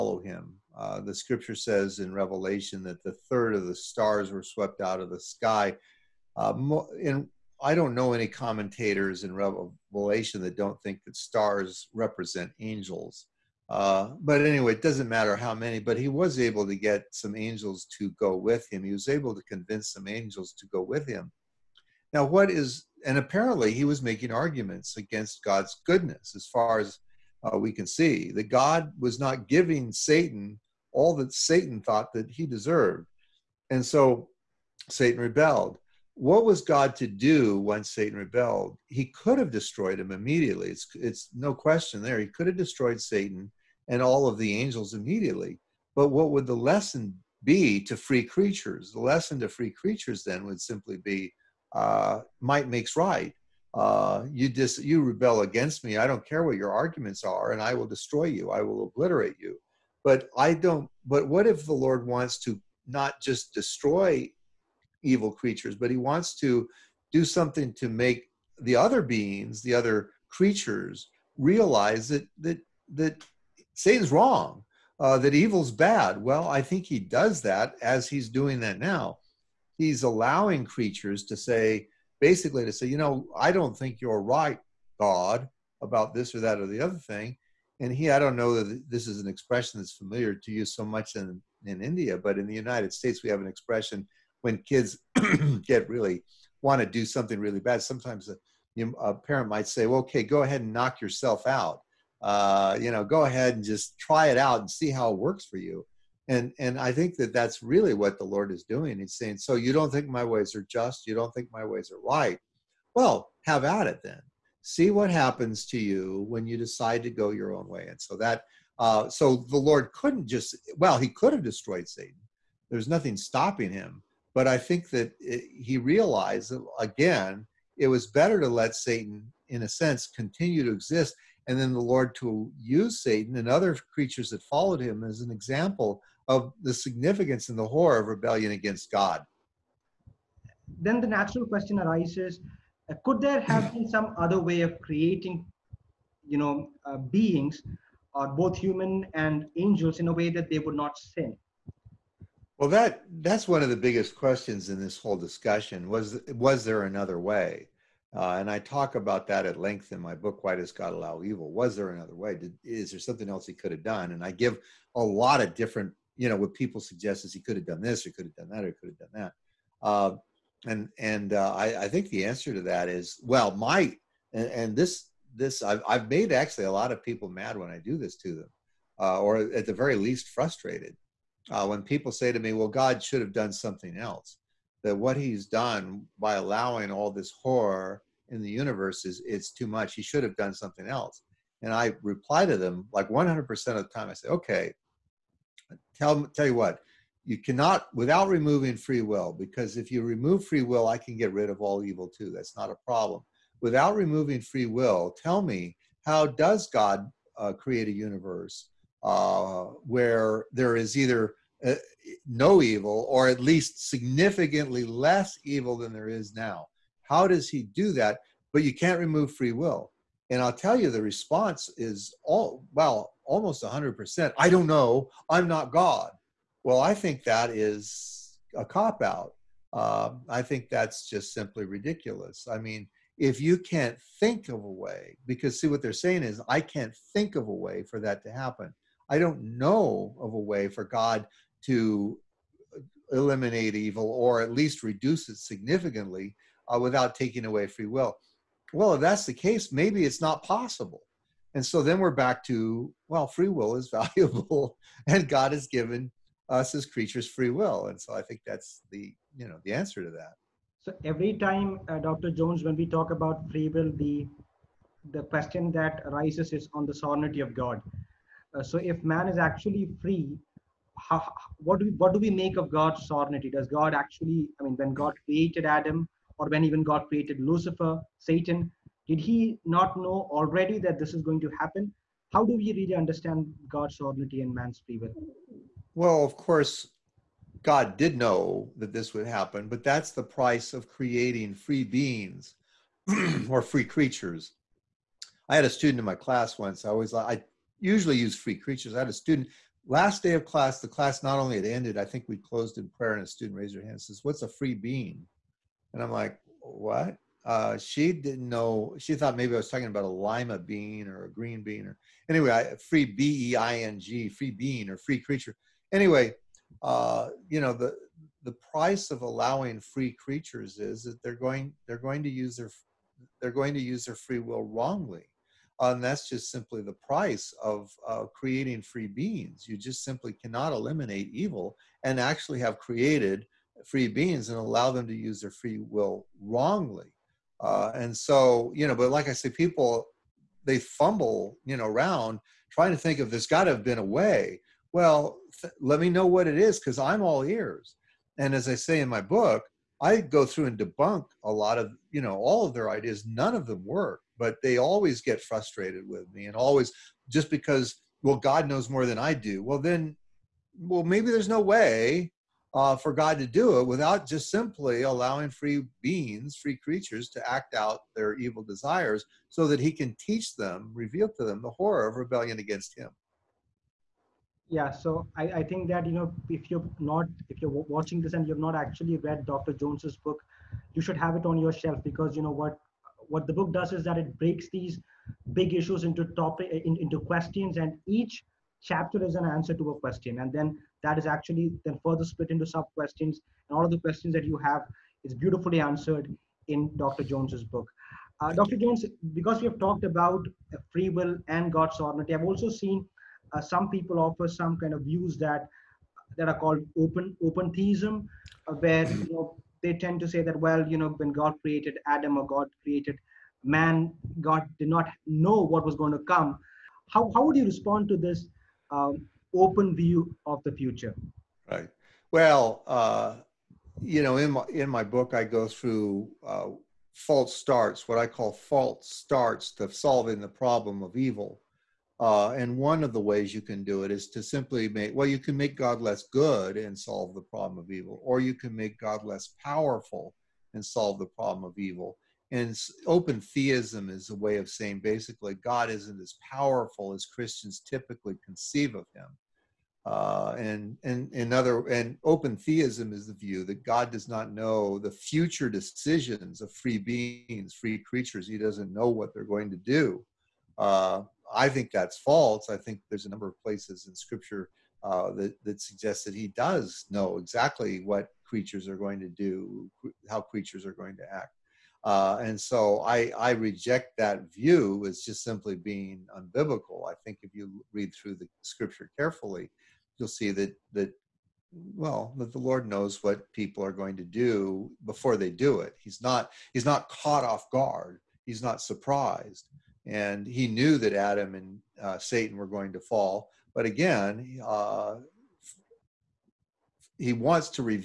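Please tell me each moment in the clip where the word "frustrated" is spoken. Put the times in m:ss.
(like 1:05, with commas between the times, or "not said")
3:00, 5:55.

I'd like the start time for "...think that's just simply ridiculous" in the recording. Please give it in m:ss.
3:50.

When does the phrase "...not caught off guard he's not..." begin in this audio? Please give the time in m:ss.
8:06.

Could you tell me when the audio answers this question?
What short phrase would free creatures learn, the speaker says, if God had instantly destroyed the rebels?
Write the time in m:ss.
0:52.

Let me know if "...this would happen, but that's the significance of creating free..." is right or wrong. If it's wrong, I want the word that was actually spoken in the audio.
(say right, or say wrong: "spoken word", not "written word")
wrong: "price", not "significance".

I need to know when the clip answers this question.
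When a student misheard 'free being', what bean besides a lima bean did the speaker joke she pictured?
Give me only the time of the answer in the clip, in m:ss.
5:11.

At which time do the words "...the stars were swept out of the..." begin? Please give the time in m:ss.
0:03.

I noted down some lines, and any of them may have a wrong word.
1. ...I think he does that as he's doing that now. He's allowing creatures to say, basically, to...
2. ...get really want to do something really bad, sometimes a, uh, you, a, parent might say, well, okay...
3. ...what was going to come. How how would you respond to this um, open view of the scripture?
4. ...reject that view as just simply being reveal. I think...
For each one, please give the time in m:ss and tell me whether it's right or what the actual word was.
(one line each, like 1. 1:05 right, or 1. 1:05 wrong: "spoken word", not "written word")
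1. 1:16 right
2. 1:35 right
3. 6:55 wrong: "future", not "scripture"
4. 7:53 wrong: "unbiblical", not "reveal".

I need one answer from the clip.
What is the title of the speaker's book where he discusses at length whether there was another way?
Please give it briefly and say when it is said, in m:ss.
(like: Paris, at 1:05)
Why Does God Allow Evil?, at 2:40.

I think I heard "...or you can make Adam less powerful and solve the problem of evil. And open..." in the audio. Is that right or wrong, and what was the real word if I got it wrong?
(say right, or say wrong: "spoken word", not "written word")
wrong: "God", not "Adam".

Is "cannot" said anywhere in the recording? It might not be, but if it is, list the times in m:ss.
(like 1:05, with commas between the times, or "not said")
3:17, 5:30.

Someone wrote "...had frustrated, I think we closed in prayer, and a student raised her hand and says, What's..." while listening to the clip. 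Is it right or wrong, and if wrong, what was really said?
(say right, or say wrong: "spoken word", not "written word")
wrong: "ended", not "frustrated".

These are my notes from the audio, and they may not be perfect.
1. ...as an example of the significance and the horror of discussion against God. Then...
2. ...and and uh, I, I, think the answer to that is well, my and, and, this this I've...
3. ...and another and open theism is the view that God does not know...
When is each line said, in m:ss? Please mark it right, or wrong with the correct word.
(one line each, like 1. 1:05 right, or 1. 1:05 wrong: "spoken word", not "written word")
1. 2:15 wrong: "rebellion", not "discussion"
2. 2:50 right
3. 7:31 right.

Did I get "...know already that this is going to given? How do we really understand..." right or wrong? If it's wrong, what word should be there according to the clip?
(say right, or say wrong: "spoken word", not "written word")
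wrong: "happen", not "given".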